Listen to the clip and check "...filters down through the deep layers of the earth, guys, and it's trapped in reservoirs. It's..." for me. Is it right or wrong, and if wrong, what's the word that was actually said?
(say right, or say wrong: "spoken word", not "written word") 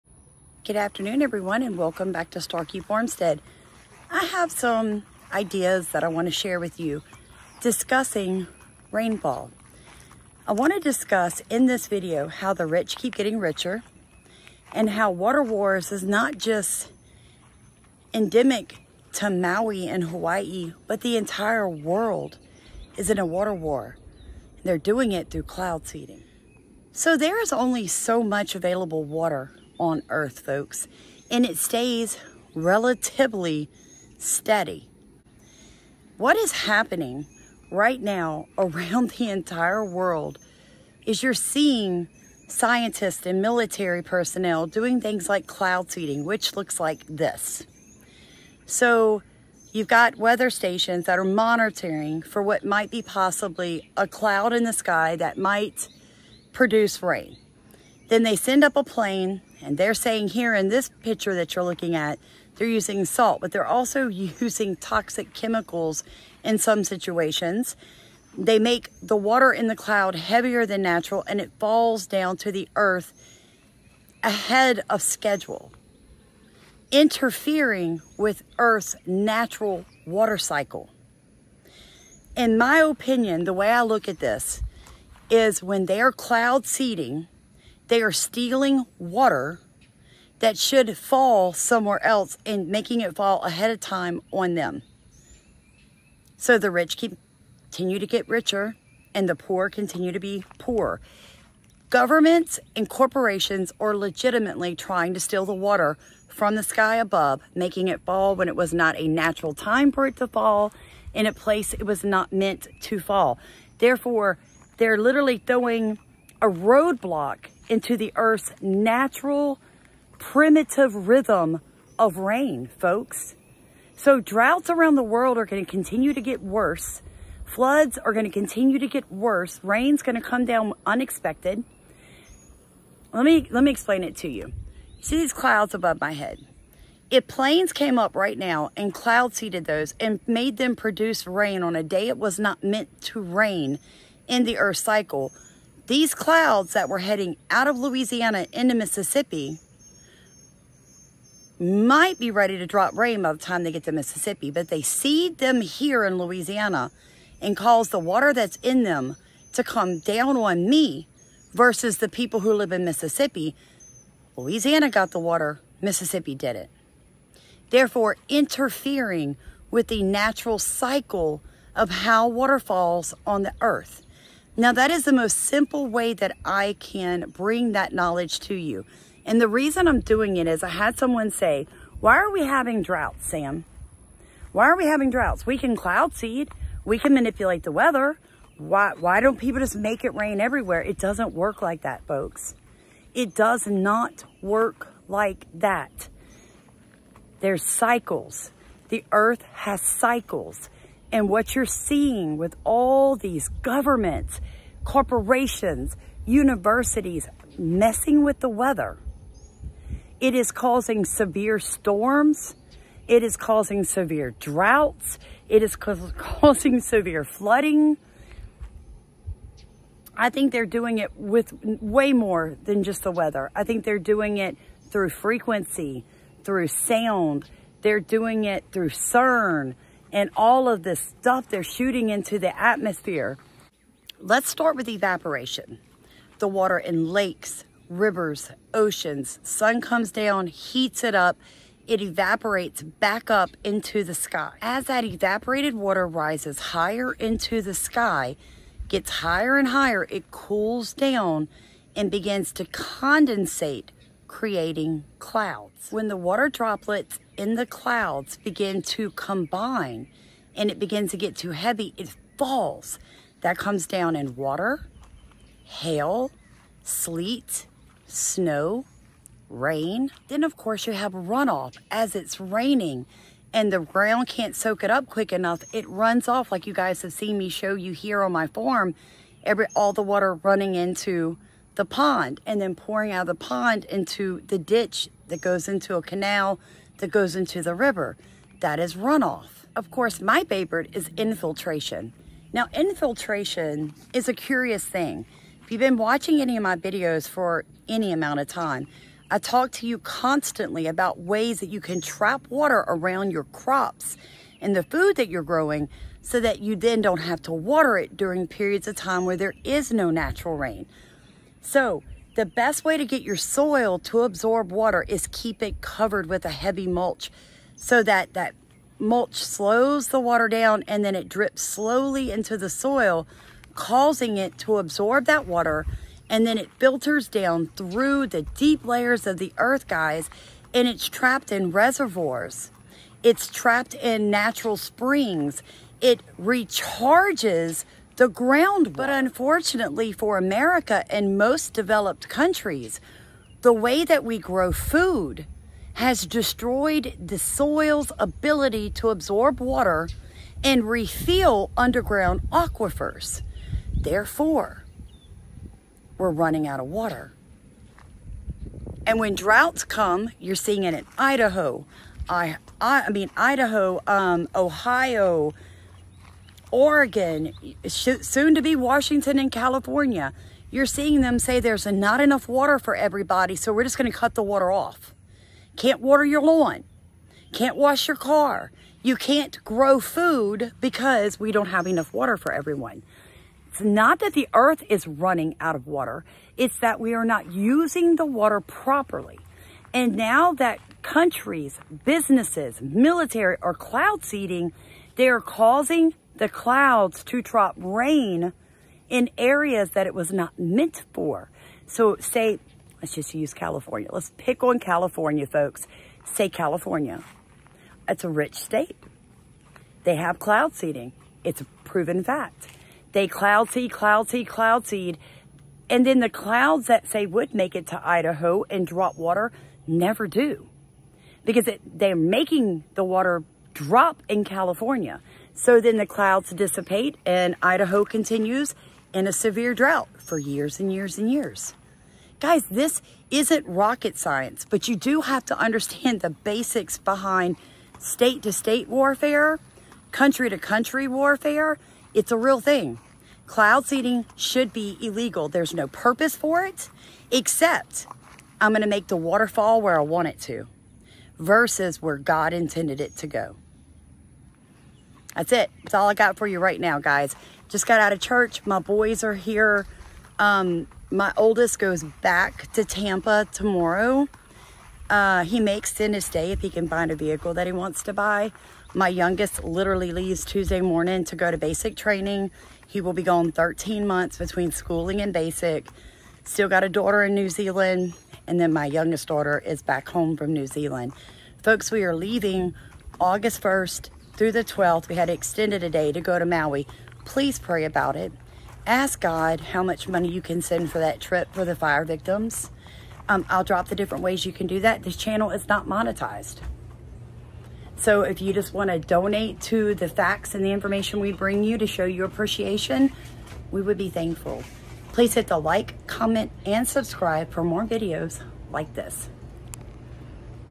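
right.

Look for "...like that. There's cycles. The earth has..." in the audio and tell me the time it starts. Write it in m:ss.
3:15.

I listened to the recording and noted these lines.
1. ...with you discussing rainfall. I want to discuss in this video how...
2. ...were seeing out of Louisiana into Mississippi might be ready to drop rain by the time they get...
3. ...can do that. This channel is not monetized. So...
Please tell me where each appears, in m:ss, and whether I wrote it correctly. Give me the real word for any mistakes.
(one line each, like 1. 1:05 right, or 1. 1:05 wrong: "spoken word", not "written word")
1. 0:06 right
2. 2:26 wrong: "heading", not "seeing"
3. 8:14 right.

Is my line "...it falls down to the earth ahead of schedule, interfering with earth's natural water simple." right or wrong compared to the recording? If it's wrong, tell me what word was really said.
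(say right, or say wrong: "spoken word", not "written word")
wrong: "cycle", not "simple".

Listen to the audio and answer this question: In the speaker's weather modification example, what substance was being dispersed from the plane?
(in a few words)
salt.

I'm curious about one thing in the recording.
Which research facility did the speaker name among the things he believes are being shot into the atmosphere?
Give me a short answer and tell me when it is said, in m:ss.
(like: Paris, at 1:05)
CERN, at 3:48.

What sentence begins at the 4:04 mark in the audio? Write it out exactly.
As that evaporated water rises higher into the sky, gets higher and higher, it cools down and begins to condensate creating clouds.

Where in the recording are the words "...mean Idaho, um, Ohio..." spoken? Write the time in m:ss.
6:03.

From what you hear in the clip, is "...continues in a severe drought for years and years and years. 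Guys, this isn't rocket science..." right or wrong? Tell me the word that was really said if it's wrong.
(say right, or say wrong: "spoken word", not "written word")
right.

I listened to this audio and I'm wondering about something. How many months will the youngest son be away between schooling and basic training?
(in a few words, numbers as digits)
13.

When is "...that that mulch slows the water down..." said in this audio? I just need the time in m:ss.
5:18.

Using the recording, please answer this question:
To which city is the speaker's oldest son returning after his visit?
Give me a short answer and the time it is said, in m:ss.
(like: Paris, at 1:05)
Tampa, at 7:42.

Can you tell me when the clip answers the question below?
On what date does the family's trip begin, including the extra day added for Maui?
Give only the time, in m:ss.
8:03.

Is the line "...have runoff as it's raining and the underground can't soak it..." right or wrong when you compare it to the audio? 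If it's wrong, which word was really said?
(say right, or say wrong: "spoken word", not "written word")
wrong: "ground", not "underground".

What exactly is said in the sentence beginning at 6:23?
It's not that the earth is running out of water.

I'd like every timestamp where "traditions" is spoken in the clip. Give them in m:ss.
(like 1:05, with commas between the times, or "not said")
not said.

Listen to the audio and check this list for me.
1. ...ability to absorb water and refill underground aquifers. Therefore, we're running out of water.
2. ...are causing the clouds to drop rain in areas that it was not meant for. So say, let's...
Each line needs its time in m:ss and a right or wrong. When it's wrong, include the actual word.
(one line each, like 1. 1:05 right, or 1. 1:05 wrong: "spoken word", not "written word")
1. 5:48 right
2. 6:35 right.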